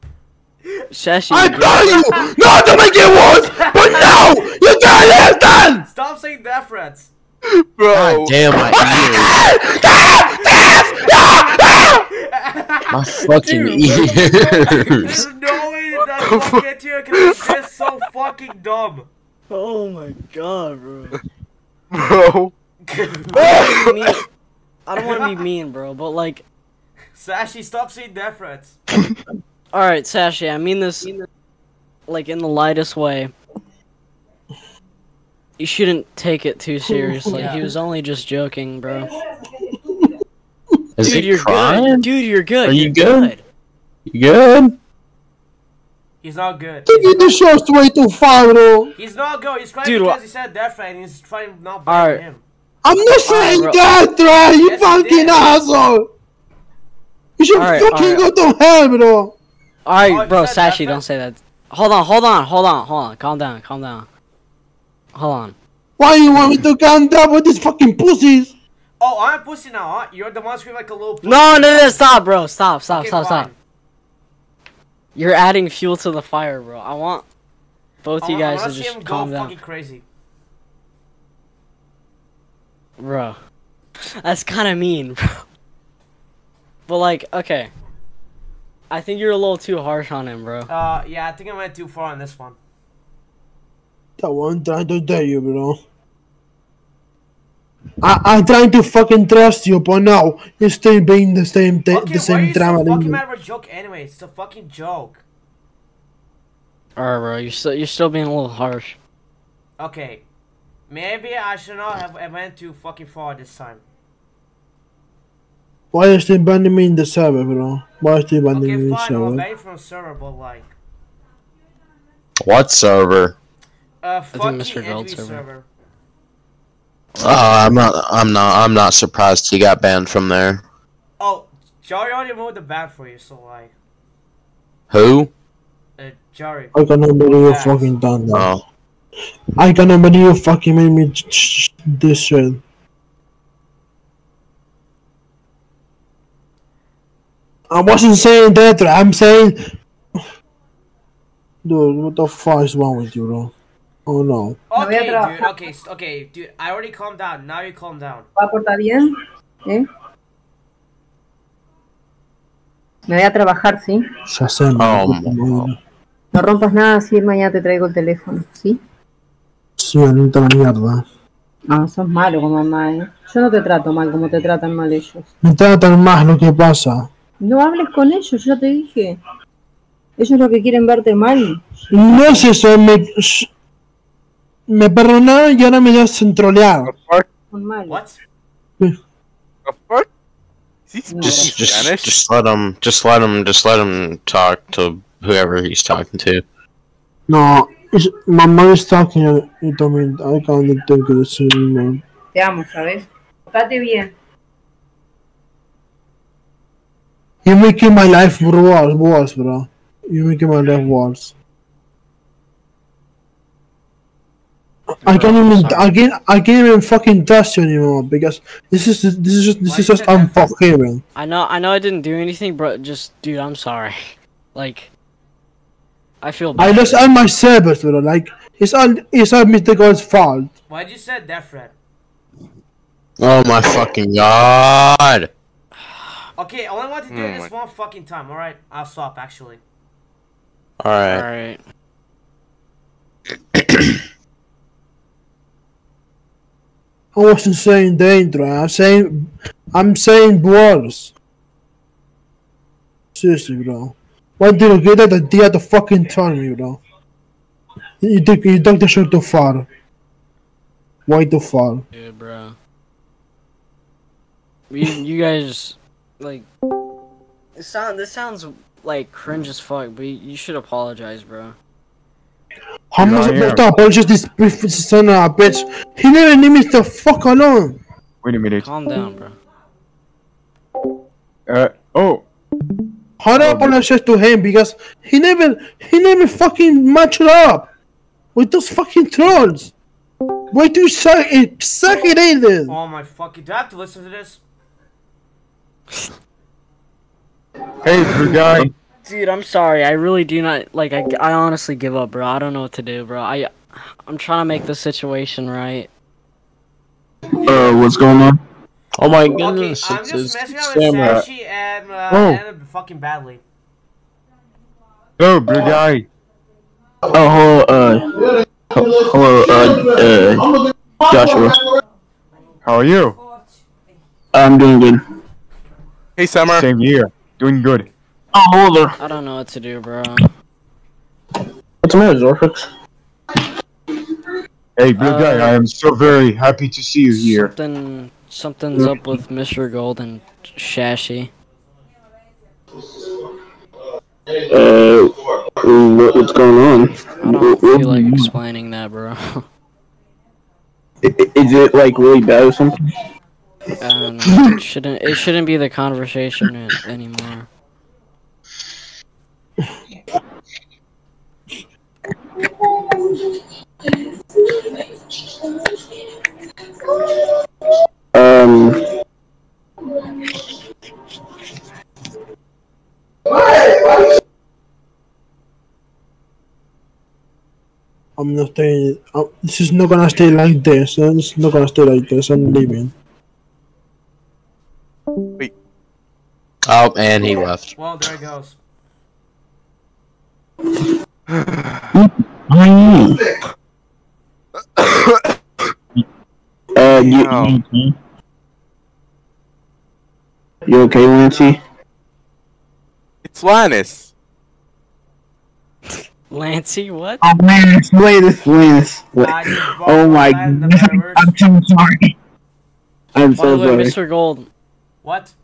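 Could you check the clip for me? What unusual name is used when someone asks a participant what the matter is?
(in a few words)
Zorfix.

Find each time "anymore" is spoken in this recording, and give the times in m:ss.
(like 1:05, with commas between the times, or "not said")
3:37, 5:56.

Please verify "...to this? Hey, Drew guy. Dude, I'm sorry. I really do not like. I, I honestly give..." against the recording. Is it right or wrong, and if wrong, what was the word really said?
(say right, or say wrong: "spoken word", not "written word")
right.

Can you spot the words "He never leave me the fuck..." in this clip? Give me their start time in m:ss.
4:35.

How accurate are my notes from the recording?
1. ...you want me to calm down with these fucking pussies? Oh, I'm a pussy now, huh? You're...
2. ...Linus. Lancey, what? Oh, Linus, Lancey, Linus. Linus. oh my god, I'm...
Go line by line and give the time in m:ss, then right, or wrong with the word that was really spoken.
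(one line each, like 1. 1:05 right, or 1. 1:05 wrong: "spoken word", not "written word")
1. 1:06 right
2. 6:43 wrong: "Linus", not "Lancey".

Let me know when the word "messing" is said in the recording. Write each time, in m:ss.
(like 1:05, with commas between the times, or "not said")
5:10.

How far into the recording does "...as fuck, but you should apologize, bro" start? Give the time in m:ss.
4:29.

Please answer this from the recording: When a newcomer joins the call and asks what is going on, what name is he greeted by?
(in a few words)
Joshua.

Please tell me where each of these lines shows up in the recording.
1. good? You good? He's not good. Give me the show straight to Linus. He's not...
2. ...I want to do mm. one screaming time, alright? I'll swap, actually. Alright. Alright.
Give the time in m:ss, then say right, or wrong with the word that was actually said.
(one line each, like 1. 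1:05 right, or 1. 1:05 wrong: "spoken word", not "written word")
1. 0:43 wrong: "Faro", not "Linus"
2. 3:56 wrong: "fucking", not "screaming".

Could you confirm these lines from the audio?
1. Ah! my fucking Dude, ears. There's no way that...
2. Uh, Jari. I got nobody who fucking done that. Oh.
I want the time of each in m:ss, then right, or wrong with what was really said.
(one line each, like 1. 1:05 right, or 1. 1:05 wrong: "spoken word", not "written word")
1. 0:12 right
2. 2:15 right.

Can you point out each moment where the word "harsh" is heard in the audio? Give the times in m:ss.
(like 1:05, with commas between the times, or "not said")
1:29, 1:48.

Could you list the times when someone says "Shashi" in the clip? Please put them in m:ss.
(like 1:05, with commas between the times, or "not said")
0:00, 5:40.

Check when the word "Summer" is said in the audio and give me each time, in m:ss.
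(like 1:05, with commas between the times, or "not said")
5:26.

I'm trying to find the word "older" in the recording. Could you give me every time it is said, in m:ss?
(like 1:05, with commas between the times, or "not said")
5:28.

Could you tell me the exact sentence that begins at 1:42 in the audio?
Okay, fucking matter of a joke anyway?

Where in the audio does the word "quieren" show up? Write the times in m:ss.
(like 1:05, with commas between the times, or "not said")
3:00.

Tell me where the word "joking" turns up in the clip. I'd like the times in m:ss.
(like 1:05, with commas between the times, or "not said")
0:38.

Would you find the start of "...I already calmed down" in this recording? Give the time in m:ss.
2:36.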